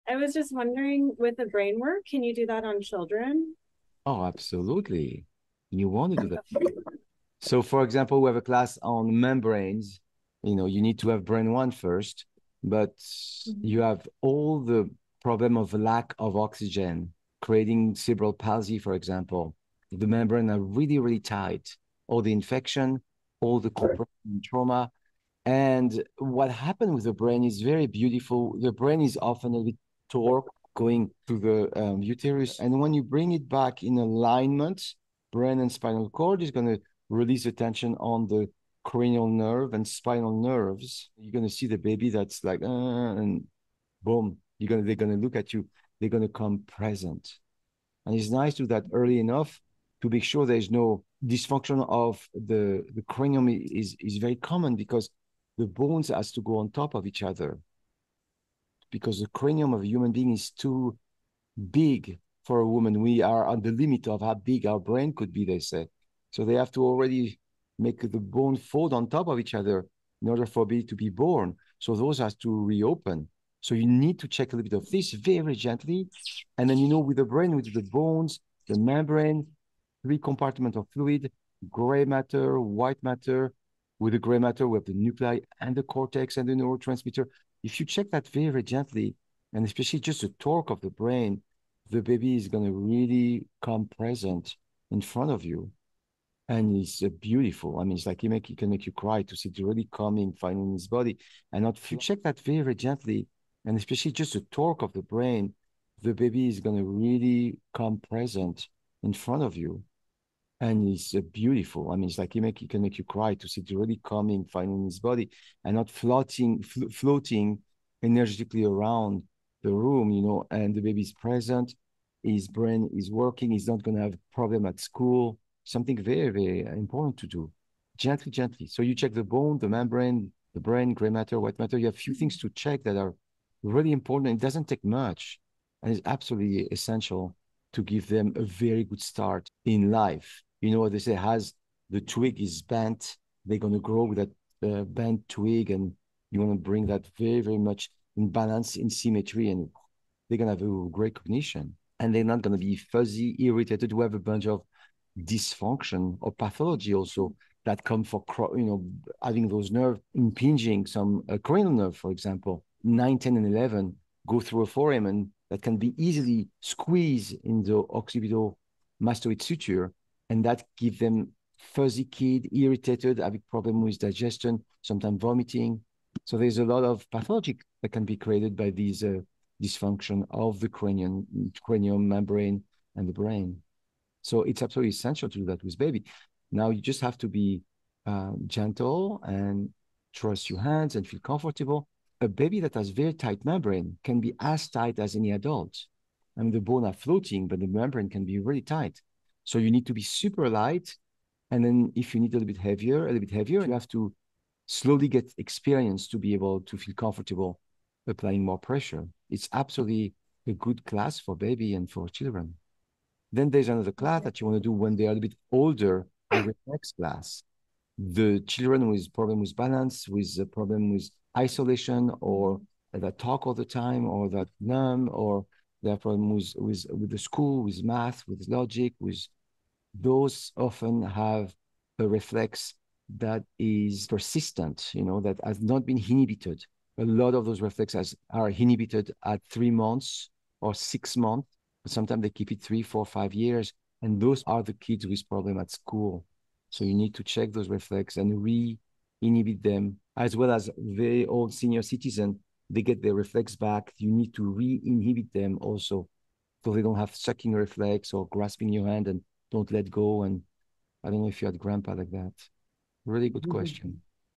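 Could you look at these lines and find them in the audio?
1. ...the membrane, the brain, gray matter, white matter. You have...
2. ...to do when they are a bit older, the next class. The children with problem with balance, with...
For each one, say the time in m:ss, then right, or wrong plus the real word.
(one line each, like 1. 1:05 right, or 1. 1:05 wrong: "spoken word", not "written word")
1. 2:09 right
2. 3:34 right.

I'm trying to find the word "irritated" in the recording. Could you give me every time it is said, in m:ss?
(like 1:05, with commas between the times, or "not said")
2:33, 2:52.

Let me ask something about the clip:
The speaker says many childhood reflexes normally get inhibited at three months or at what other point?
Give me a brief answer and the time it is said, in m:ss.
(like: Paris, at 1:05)
6 months, at 4:00.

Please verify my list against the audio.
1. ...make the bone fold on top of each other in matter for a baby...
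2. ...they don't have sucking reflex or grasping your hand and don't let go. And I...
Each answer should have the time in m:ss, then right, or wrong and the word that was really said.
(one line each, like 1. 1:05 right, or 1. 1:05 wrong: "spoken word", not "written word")
1. 1:07 wrong: "order", not "matter"
2. 4:16 right.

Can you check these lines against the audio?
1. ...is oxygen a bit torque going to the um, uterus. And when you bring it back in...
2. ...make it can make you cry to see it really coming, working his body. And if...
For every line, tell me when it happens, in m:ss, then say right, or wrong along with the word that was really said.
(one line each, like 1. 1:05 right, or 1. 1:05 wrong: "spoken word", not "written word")
1. 0:29 wrong: "often", not "oxygen"
2. 1:38 wrong: "finding", not "working".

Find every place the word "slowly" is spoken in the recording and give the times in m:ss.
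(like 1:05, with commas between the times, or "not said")
3:24.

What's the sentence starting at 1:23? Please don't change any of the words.
With the gray matter, we have the nuclei and the cortex and the neurotransmitter.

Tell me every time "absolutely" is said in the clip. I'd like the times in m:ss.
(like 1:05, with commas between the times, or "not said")
0:04, 2:16, 3:04, 3:29.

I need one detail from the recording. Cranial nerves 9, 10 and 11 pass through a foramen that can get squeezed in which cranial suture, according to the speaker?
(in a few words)
occipital mastoid suture.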